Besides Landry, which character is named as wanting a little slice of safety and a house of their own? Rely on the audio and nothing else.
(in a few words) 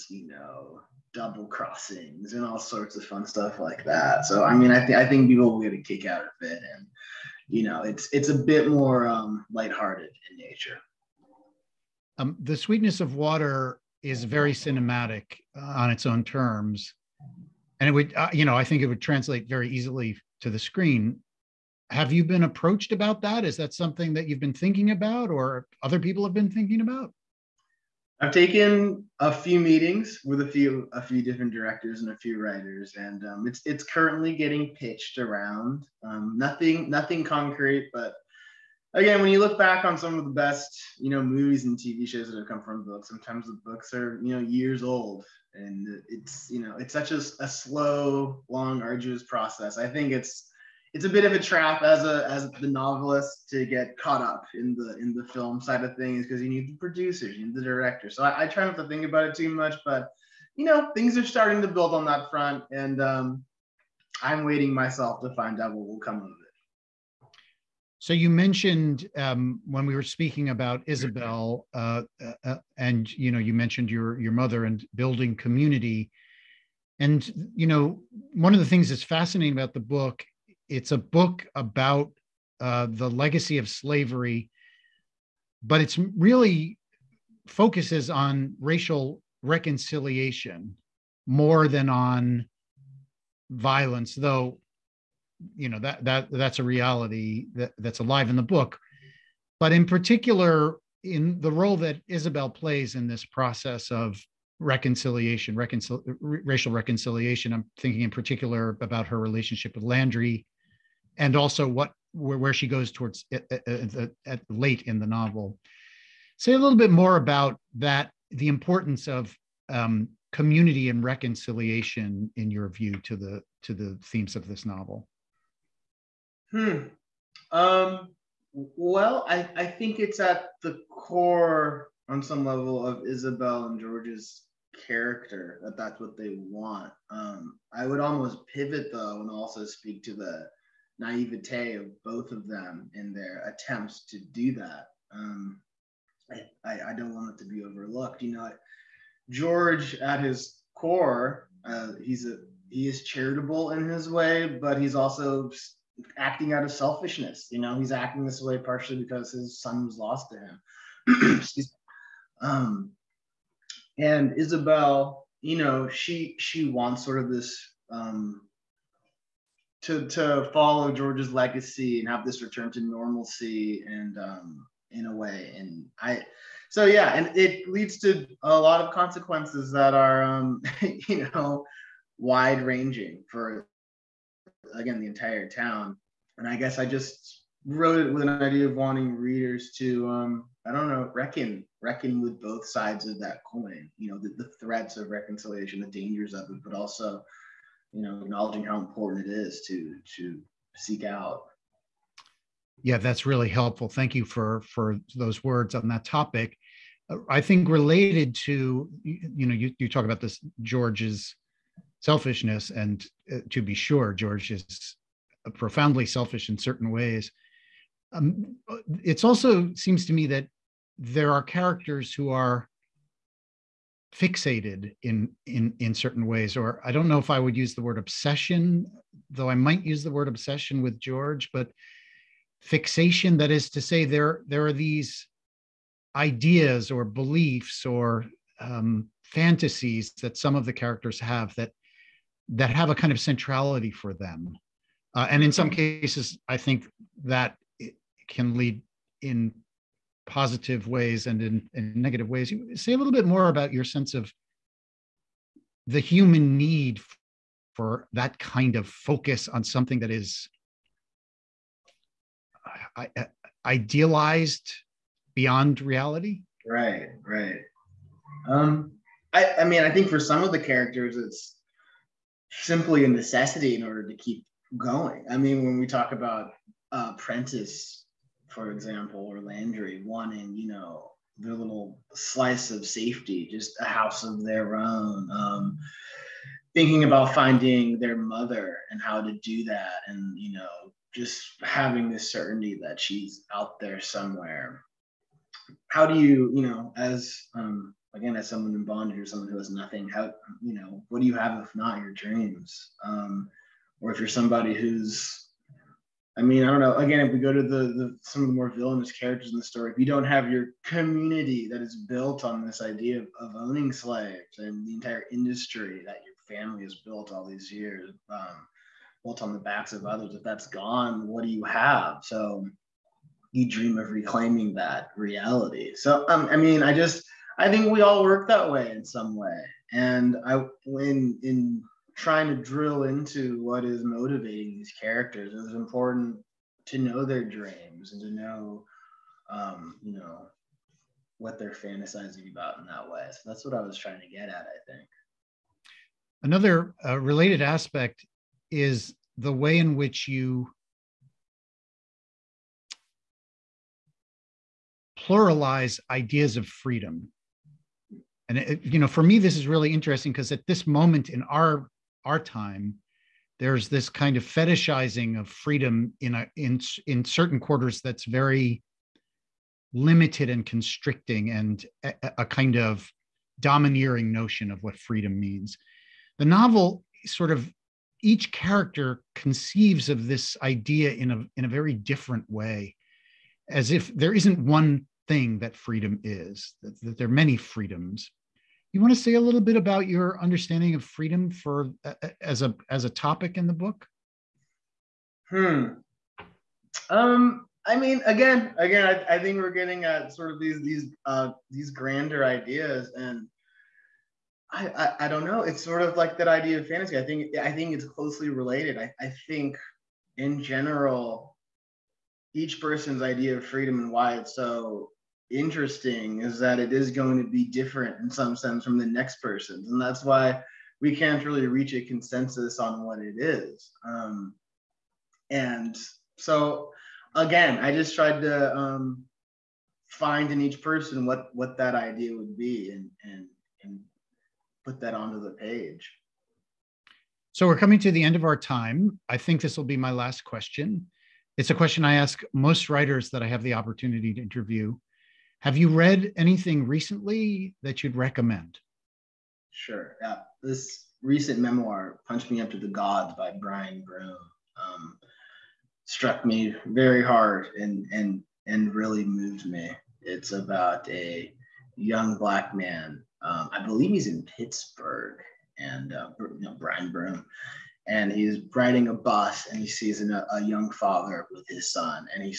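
Prentice.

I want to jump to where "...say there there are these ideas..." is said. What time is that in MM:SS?
03:53.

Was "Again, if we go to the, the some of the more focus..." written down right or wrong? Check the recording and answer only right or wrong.
wrong.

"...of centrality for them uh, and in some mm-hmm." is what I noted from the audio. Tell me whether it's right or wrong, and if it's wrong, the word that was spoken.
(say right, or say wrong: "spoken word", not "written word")
right.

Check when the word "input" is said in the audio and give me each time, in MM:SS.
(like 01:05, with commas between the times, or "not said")
not said.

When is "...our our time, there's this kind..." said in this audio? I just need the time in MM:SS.
06:01.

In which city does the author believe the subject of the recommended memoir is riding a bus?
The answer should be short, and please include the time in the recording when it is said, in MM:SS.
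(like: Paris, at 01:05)
Pittsburgh, at 07:44.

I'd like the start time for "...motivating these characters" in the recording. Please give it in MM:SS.
05:34.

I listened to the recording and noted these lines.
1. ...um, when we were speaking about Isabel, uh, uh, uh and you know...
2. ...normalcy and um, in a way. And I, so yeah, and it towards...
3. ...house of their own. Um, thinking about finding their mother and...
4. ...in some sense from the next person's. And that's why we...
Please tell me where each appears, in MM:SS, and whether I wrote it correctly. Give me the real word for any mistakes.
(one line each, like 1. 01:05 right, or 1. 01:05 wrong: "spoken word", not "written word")
1. 01:09 right
2. 02:52 wrong: "leads", not "towards"
3. 04:43 right
4. 06:58 right.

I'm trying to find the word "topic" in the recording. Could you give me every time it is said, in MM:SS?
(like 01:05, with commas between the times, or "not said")
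03:26, 06:33.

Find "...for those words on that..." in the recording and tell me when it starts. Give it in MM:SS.
03:24.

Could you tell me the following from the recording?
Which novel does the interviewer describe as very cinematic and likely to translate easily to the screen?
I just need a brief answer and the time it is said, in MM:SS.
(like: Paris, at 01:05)
The Sweetness of Water, at 00:12.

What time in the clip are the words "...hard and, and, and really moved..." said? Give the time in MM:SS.
07:37.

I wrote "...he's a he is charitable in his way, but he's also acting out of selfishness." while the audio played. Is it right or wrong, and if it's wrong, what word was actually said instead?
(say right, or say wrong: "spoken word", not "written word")
right.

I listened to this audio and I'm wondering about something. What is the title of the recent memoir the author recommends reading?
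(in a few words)
Punch Me Up to the Gods.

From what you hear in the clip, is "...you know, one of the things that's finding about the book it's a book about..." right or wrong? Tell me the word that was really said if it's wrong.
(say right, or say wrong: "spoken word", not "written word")
wrong: "fascinating", not "finding".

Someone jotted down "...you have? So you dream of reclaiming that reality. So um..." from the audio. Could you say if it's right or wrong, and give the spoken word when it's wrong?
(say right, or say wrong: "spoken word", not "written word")
right.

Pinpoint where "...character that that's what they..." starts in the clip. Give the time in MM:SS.
02:14.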